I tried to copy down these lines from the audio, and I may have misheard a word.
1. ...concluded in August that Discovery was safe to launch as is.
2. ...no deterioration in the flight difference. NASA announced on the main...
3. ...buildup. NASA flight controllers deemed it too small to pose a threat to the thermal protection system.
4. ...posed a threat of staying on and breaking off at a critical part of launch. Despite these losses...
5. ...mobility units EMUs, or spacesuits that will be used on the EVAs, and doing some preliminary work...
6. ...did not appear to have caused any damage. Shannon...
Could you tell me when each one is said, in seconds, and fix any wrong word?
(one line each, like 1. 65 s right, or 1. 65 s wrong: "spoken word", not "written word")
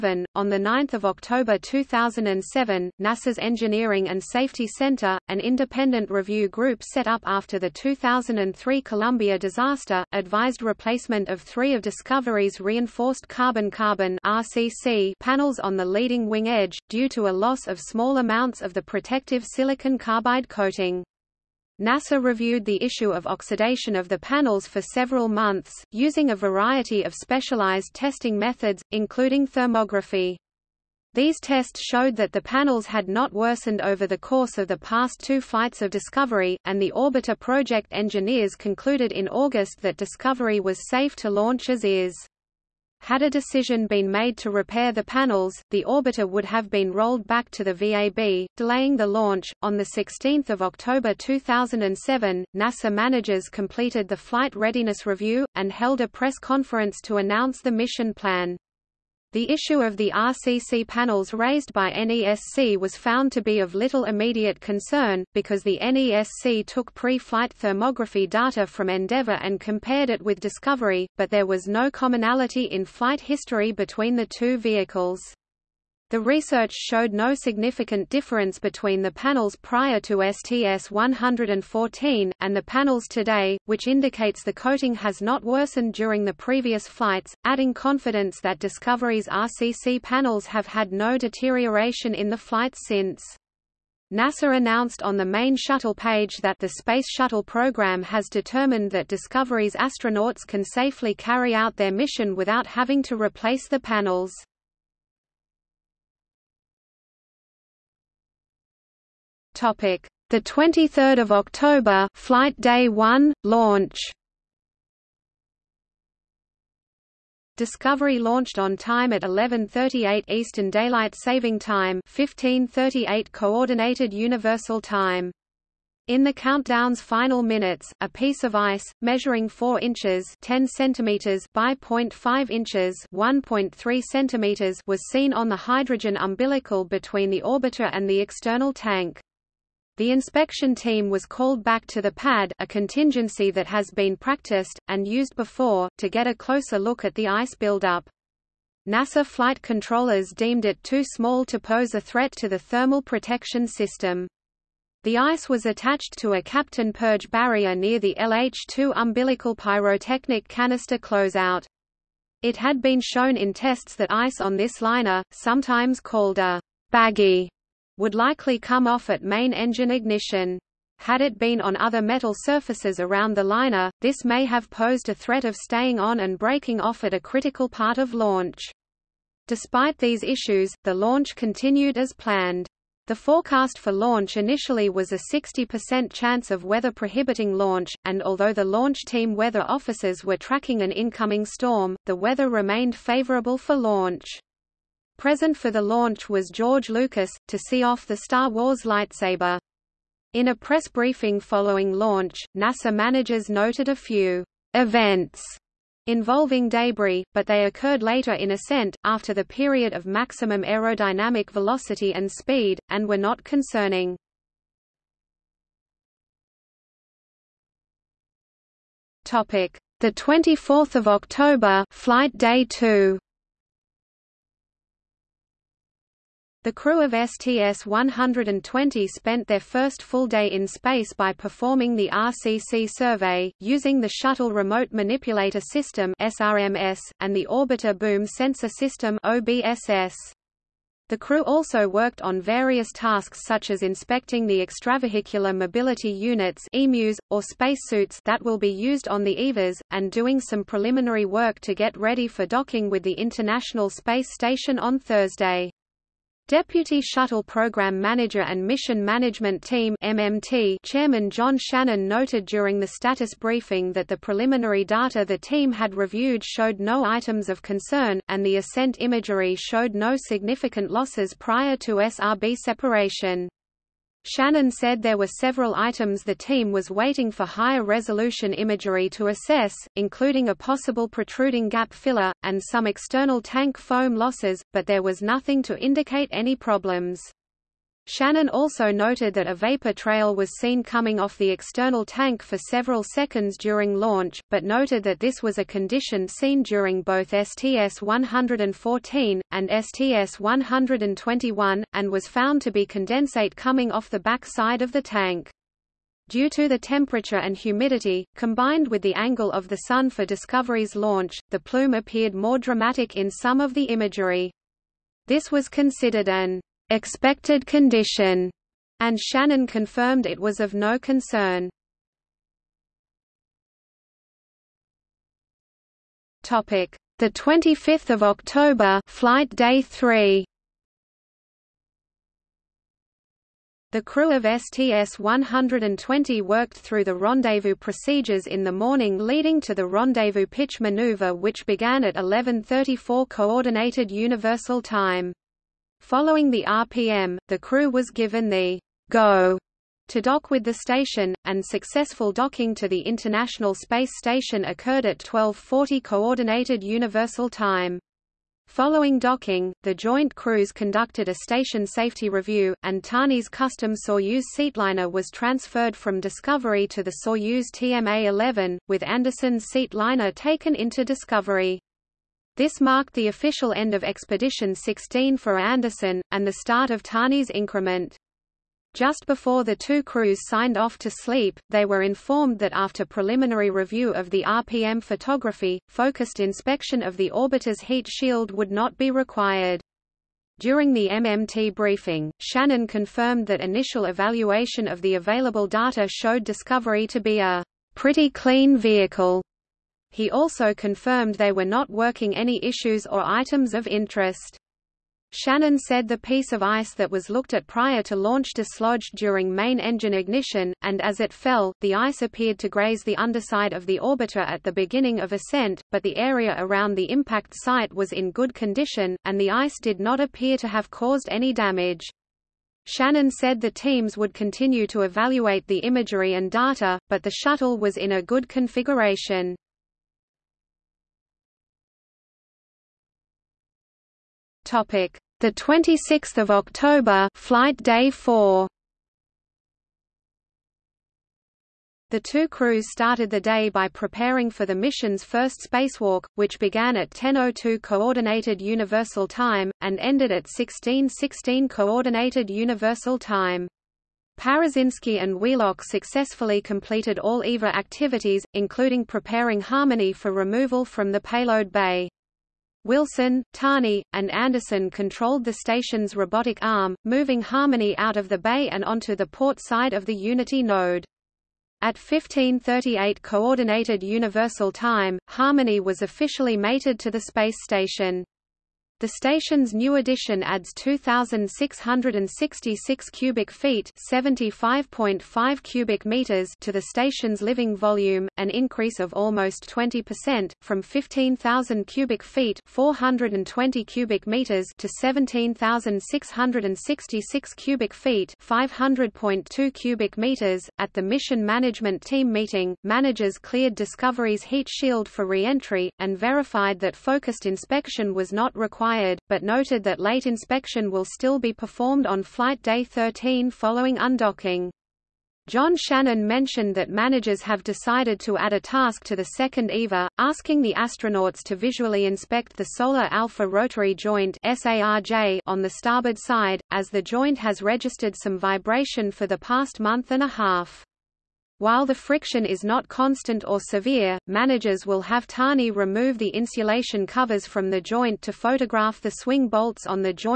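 1. 38 s right
2. 90 s wrong: "since", not "difference"
3. 147 s right
4. 174 s wrong: "issues", not "losses"
5. 245 s right
6. 419 s right.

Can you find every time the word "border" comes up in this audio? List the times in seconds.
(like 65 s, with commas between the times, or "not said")
not said.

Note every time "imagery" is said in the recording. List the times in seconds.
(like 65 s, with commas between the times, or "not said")
268 s, 278 s, 313 s, 425 s.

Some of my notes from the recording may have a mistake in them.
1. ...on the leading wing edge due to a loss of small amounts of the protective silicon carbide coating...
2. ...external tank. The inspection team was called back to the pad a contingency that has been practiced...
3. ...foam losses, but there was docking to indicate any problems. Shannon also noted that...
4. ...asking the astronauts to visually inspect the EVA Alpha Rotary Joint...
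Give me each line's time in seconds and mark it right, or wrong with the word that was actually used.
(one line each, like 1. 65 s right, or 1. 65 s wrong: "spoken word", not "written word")
1. 15 s right
2. 138 s right
3. 283 s wrong: "nothing", not "docking"
4. 520 s wrong: "Solar", not "EVA".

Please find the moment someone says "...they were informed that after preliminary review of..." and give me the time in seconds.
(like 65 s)
381 s.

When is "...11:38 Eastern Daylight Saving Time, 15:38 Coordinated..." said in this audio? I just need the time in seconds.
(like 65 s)
119 s.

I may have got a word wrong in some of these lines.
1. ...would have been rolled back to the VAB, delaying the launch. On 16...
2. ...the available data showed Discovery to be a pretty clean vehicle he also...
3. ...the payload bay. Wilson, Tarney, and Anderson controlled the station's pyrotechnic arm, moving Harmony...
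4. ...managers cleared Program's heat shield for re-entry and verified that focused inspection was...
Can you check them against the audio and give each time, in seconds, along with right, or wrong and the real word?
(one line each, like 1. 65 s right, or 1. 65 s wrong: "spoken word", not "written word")
1. 46 s right
2. 395 s right
3. 461 s wrong: "robotic", not "pyrotechnic"
4. 502 s wrong: "Discovery", not "Program".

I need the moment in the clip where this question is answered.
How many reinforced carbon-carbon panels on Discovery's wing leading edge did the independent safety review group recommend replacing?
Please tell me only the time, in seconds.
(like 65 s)
11 s.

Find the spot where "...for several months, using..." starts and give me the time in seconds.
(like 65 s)
24 s.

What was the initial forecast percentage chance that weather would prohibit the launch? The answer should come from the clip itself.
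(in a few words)
60%.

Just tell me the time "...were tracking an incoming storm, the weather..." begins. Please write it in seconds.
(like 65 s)
190 s.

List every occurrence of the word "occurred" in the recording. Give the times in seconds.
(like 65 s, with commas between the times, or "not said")
207 s, 354 s.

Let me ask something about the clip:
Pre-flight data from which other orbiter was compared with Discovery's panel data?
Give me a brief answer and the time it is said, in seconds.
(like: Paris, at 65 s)
Endeavour, at 68 s.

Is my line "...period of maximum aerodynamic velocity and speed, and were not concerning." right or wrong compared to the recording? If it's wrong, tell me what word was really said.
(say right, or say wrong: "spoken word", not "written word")
right.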